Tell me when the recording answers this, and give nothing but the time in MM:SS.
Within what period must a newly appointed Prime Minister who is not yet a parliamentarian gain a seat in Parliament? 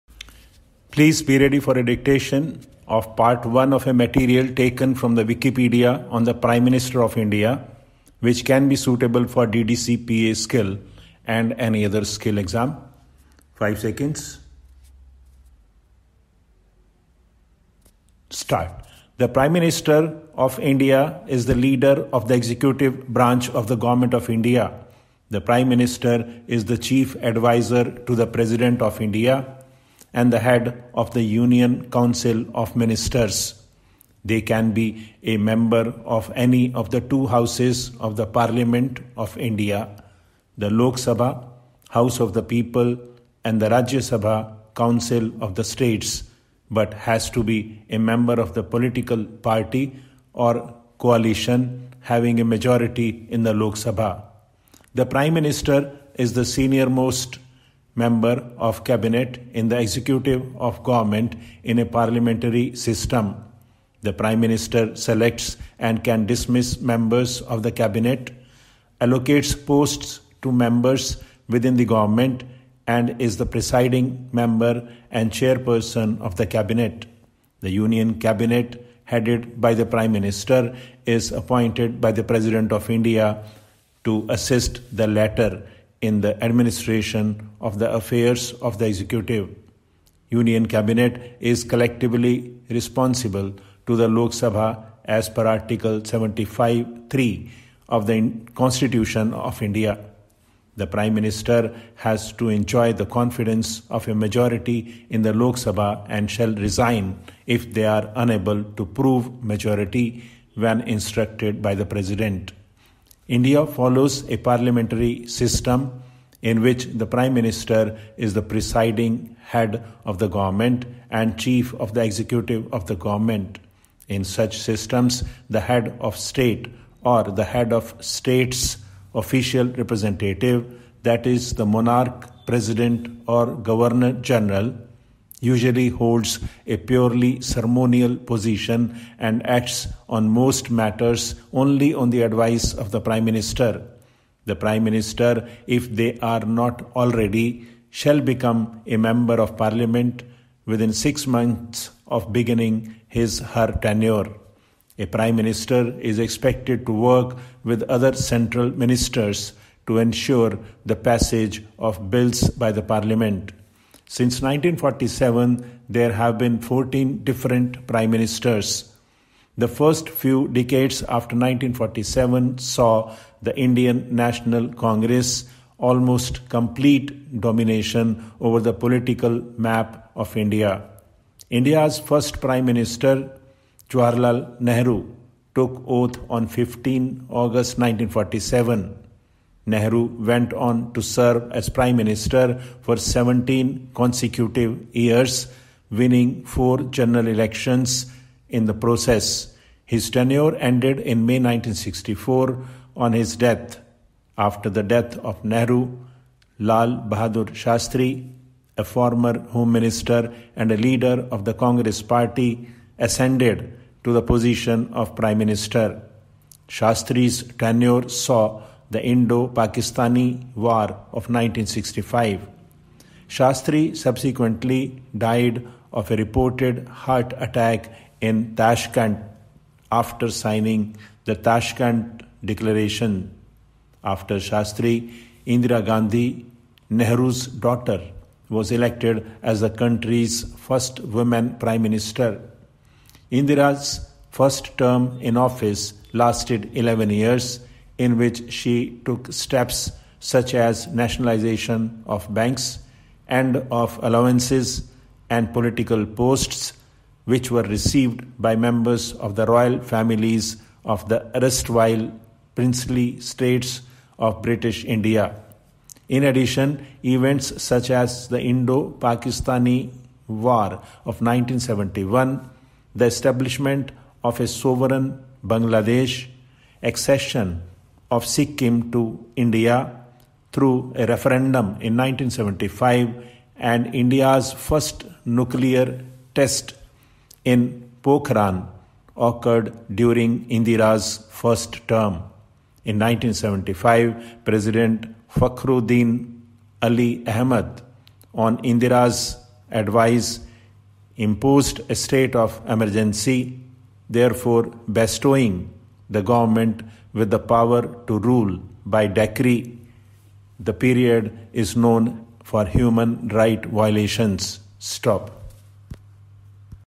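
02:30.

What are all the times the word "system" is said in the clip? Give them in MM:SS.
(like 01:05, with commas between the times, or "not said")
01:02, 01:55, 02:04.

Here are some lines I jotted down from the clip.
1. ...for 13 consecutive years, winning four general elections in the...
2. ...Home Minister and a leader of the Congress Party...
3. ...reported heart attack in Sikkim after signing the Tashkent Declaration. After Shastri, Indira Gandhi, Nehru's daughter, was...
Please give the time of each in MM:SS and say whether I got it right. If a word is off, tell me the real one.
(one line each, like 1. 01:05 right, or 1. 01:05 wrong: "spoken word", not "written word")
1. 03:12 wrong: "17", not "13"
2. 03:29 right
3. 03:46 wrong: "Tashkent", not "Sikkim".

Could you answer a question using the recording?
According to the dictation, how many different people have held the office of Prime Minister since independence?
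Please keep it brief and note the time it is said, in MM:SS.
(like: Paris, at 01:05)
14, at 02:46.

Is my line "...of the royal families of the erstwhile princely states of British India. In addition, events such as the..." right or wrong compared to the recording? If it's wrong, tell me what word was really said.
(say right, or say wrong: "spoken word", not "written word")
right.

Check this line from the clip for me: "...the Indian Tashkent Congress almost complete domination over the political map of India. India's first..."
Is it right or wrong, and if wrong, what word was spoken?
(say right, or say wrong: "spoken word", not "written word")
wrong: "National", not "Tashkent".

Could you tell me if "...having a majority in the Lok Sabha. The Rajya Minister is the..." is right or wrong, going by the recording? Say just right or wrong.
wrong.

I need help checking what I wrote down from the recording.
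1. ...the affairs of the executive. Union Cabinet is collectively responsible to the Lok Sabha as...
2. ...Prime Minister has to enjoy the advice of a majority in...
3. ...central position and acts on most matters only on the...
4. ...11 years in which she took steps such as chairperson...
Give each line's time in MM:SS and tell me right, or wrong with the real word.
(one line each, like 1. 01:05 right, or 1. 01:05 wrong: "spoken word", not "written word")
1. 01:27 right
2. 01:40 wrong: "confidence", not "advice"
3. 02:17 wrong: "ceremonial", not "central"
4. 04:06 wrong: "nationalization", not "chairperson".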